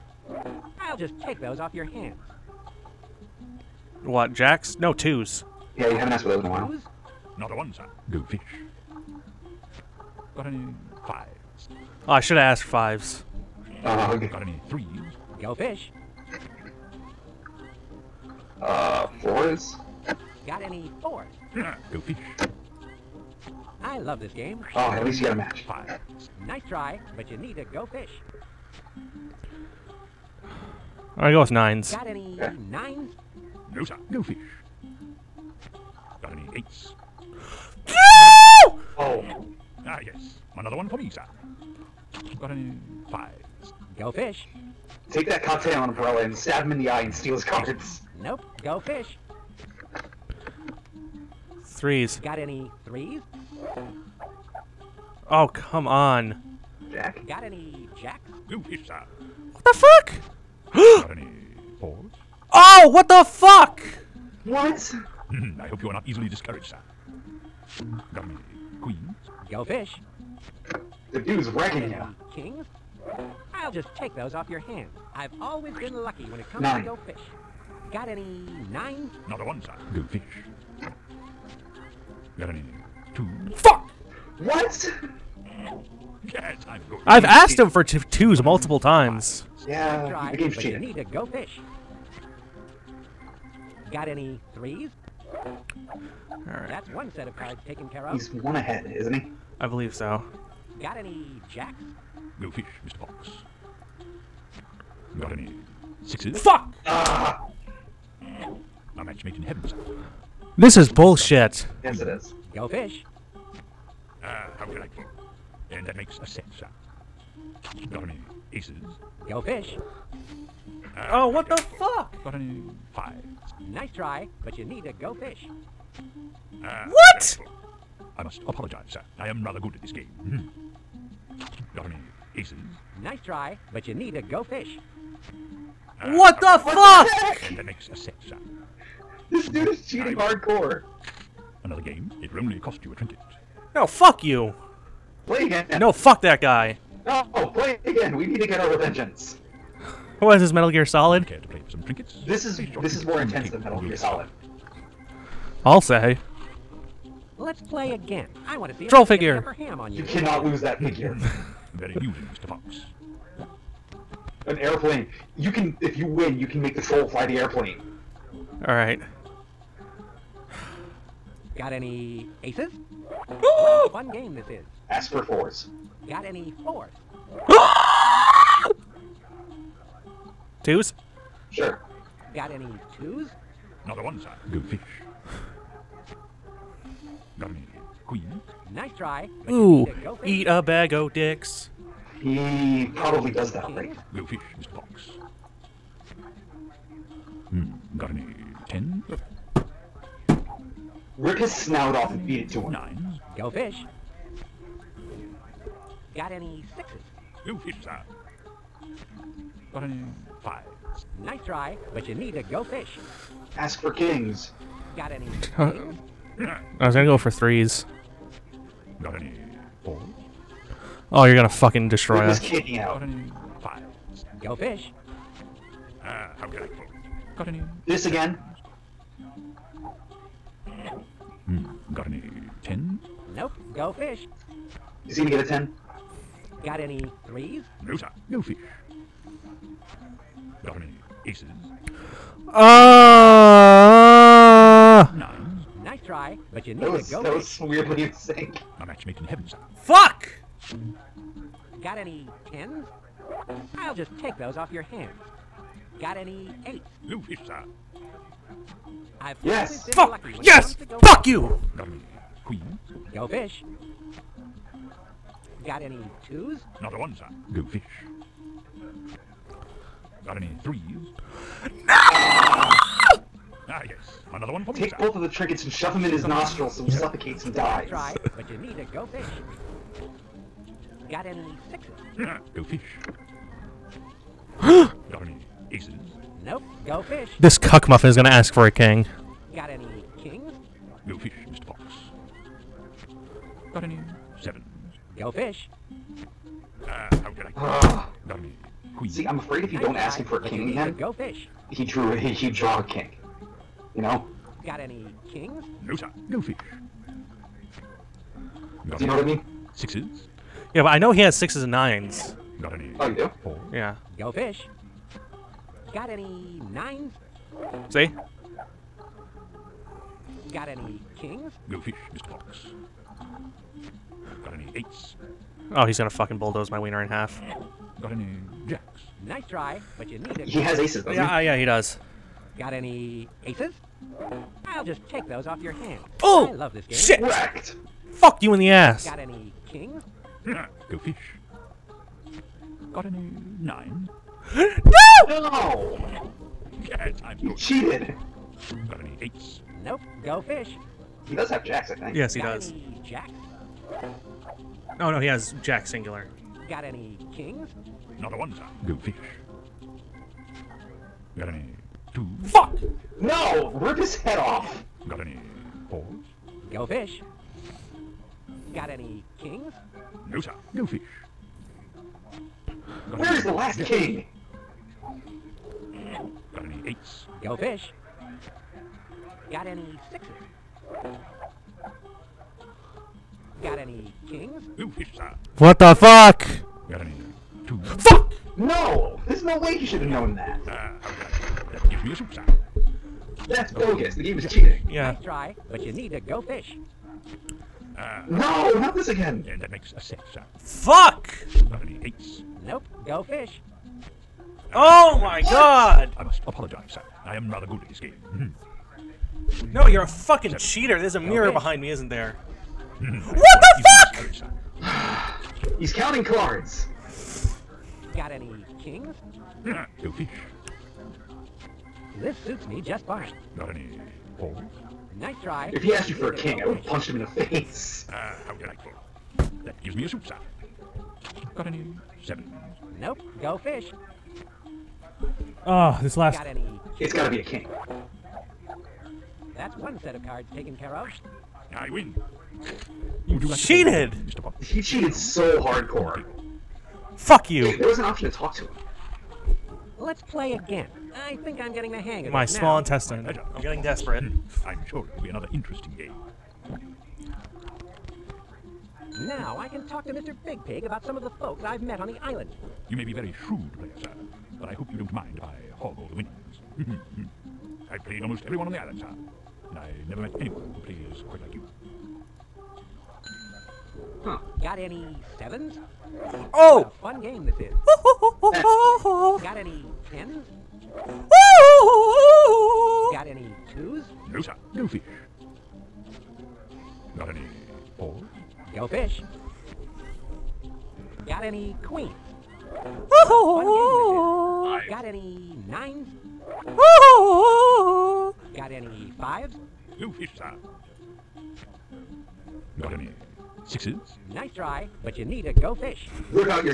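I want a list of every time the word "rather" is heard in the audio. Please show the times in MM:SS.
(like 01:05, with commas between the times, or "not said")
02:09, 06:47.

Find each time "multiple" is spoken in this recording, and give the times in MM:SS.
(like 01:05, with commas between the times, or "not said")
01:28.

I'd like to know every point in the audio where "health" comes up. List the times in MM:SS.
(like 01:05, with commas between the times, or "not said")
not said.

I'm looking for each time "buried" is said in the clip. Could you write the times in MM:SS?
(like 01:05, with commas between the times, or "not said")
not said.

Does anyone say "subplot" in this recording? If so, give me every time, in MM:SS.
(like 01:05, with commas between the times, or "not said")
not said.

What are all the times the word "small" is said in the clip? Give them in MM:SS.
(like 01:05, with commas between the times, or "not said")
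07:32.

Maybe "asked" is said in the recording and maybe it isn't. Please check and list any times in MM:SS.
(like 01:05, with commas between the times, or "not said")
00:06, 00:12, 01:27, 07:05.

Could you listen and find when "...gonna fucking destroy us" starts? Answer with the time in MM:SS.
03:41.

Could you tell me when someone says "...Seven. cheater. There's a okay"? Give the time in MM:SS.
06:50.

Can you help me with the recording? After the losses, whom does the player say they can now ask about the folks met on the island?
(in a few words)
Mr. Big Pig.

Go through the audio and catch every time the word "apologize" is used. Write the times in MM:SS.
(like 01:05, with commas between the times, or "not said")
02:08, 06:46.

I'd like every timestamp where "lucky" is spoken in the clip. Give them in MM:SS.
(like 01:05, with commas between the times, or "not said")
01:16.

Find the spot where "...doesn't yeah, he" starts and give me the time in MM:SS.
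05:31.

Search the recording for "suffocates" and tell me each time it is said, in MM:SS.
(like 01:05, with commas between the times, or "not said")
04:36.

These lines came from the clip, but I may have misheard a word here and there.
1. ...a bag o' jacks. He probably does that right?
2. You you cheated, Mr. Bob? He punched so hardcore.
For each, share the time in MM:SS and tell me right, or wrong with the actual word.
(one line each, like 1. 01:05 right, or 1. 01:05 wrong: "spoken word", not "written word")
1. 03:10 wrong: "dicks", not "jacks"
2. 07:23 wrong: "cheated", not "punched".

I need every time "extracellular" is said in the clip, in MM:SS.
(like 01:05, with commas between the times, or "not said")
not said.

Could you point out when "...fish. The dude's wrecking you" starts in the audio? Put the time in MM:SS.
01:09.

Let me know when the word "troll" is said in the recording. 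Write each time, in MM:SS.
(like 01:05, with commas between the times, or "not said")
02:38, 02:46.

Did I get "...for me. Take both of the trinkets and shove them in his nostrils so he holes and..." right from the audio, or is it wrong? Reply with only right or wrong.
wrong.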